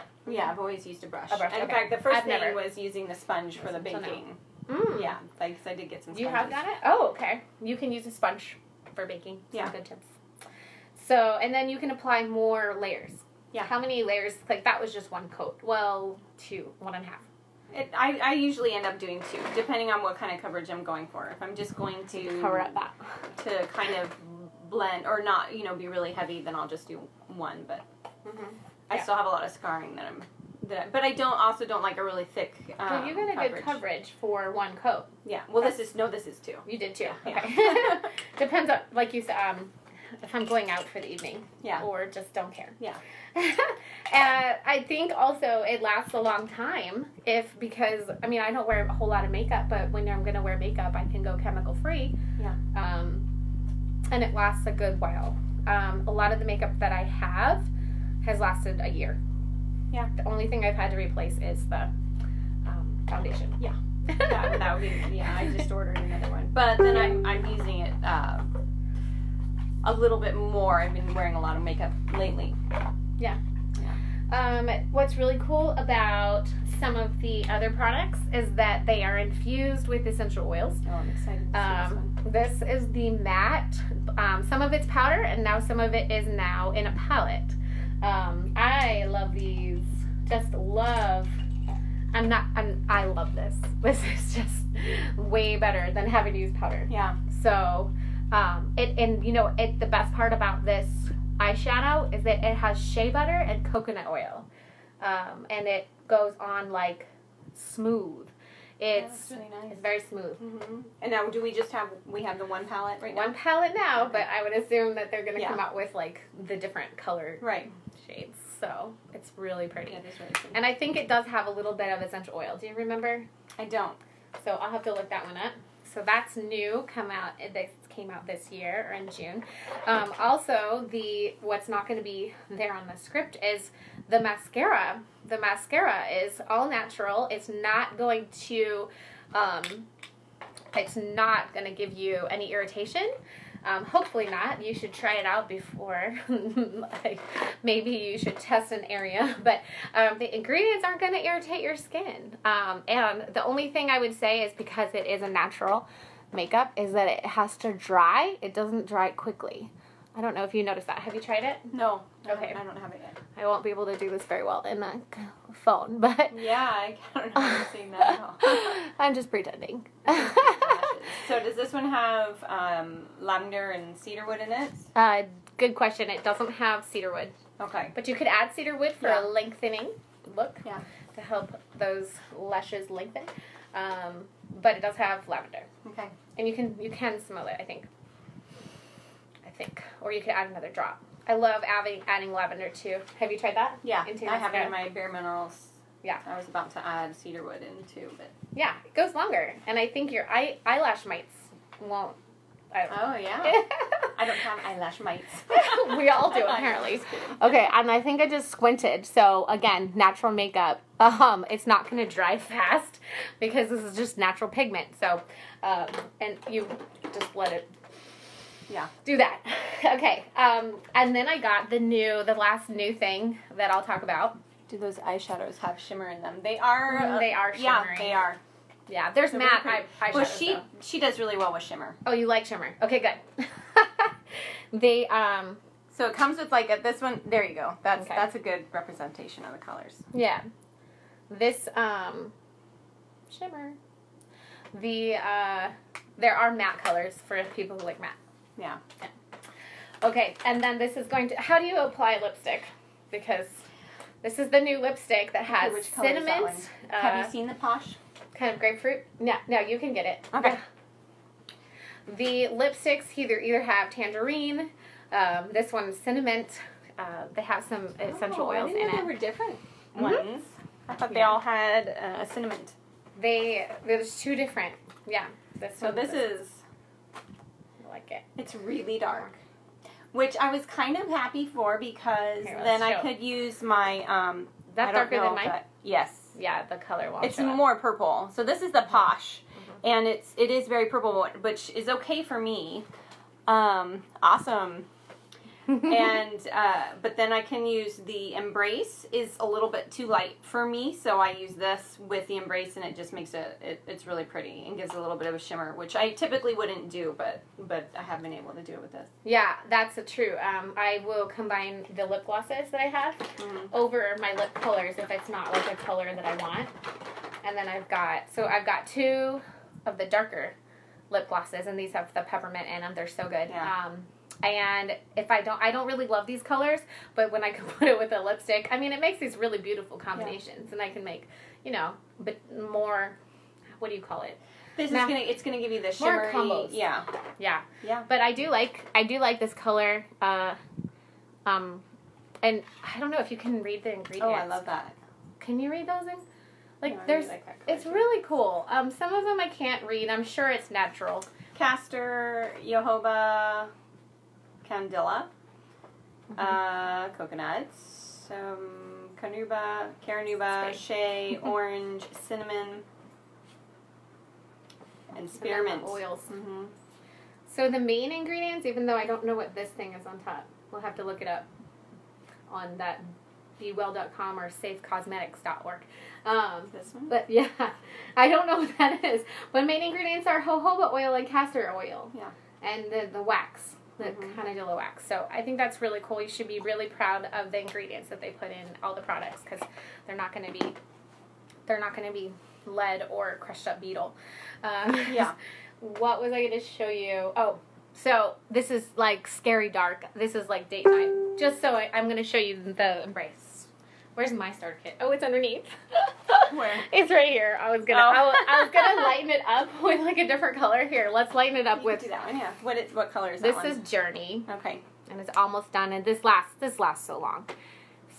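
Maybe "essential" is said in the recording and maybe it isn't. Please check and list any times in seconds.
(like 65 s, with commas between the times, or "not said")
80 s, 122 s, 267 s.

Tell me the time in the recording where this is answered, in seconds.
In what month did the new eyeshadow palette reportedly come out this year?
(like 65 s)
129 s.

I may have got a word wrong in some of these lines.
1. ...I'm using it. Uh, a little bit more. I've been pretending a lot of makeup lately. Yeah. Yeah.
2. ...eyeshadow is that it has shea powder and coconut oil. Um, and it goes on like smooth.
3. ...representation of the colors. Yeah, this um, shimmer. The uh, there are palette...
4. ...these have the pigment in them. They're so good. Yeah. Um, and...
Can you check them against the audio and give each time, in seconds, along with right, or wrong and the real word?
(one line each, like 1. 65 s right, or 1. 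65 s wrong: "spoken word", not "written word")
1. 67 s wrong: "wearing", not "pretending"
2. 101 s wrong: "butter", not "powder"
3. 238 s wrong: "matte", not "palette"
4. 321 s wrong: "peppermint", not "pigment".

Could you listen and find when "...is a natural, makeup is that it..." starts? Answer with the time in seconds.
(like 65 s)
155 s.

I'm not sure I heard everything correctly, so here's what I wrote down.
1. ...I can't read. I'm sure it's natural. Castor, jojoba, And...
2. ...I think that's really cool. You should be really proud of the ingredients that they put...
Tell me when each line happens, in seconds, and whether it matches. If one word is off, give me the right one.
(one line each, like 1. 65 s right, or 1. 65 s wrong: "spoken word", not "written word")
1. 349 s wrong: "Candela", not "And"
2. 385 s right.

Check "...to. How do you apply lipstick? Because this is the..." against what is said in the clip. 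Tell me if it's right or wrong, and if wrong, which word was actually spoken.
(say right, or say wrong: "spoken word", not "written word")
right.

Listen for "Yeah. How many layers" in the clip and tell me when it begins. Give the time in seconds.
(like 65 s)
13 s.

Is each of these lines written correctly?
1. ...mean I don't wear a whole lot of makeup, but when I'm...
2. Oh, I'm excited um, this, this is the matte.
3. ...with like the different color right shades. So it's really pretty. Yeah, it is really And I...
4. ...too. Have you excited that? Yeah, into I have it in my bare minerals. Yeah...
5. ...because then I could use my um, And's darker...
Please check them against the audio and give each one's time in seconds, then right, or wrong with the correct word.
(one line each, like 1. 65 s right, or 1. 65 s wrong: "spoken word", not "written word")
1. 48 s right
2. 80 s right
3. 115 s right
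4. 192 s wrong: "tried", not "excited"
5. 281 s wrong: "That", not "And".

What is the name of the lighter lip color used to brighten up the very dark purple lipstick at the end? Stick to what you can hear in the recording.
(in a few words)
Journey.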